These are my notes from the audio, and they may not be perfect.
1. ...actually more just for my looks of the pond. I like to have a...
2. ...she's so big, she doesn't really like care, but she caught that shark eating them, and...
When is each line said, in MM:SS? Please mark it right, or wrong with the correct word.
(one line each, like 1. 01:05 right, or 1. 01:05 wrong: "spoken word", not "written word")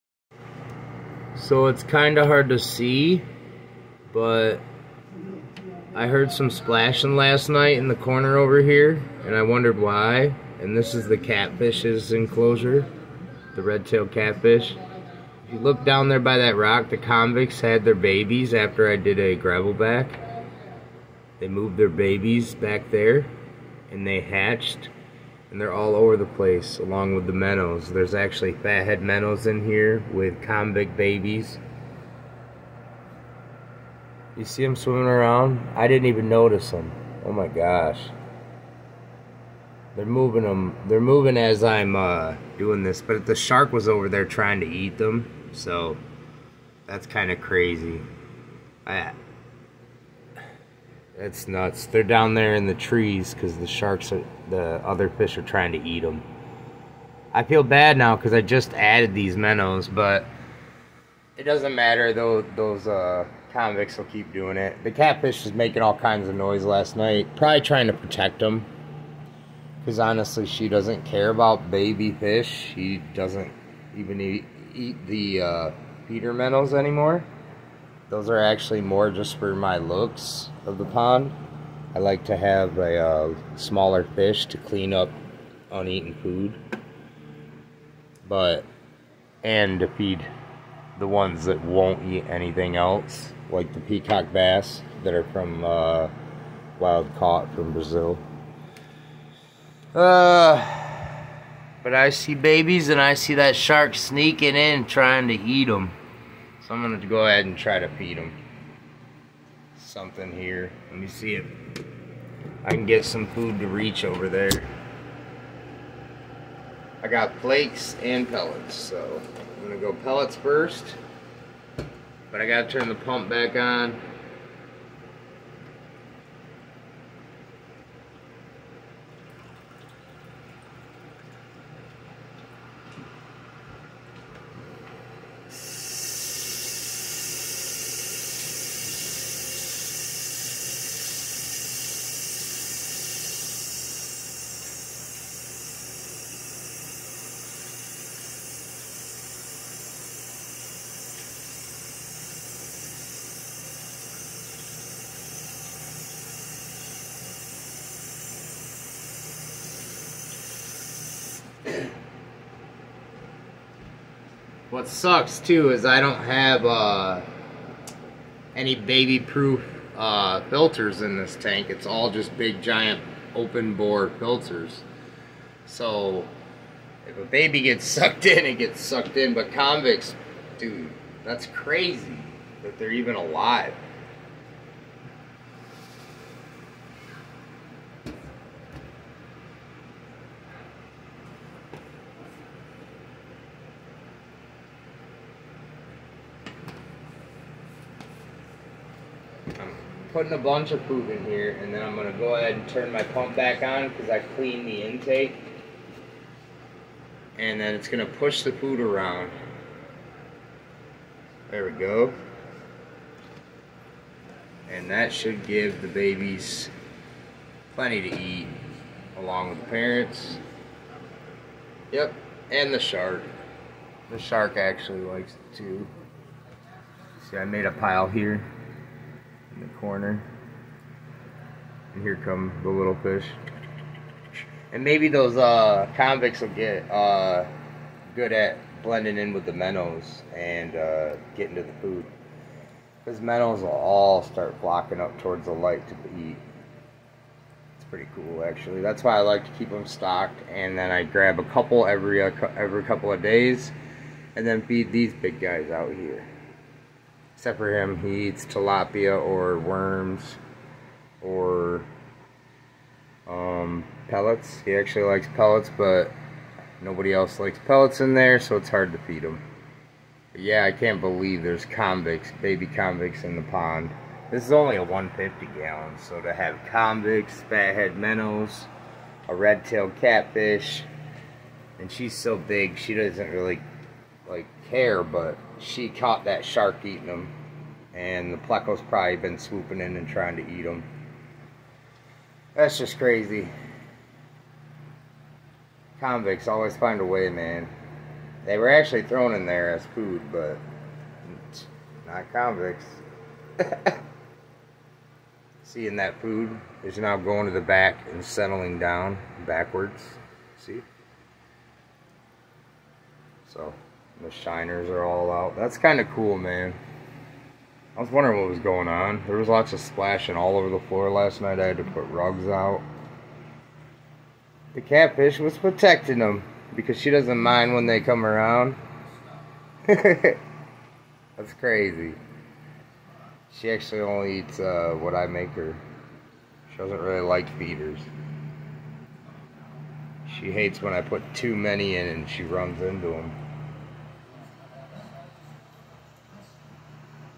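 1. 01:18 right
2. 04:41 right.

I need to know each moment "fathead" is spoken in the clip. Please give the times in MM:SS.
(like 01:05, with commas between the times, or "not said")
00:28, 04:37.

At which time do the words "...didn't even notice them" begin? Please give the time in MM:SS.
00:35.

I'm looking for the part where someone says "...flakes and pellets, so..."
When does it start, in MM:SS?
01:57.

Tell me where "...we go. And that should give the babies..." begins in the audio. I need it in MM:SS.
03:31.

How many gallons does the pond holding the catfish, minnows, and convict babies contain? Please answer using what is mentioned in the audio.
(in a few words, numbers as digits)
150.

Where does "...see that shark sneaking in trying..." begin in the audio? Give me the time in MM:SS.
01:43.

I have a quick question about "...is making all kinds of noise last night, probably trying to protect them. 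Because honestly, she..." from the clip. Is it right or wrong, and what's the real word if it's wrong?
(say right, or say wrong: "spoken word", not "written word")
right.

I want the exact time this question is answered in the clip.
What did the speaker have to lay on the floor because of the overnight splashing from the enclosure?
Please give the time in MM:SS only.
05:22.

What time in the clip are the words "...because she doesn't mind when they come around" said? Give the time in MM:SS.
05:26.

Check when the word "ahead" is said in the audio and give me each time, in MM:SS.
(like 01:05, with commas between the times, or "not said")
01:47, 03:22.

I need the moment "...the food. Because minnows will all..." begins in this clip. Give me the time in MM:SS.
04:01.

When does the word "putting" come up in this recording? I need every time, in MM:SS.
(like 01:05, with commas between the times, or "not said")
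03:20.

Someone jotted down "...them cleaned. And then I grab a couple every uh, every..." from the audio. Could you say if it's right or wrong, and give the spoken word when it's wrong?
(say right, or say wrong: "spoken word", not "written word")
wrong: "stocked", not "cleaned".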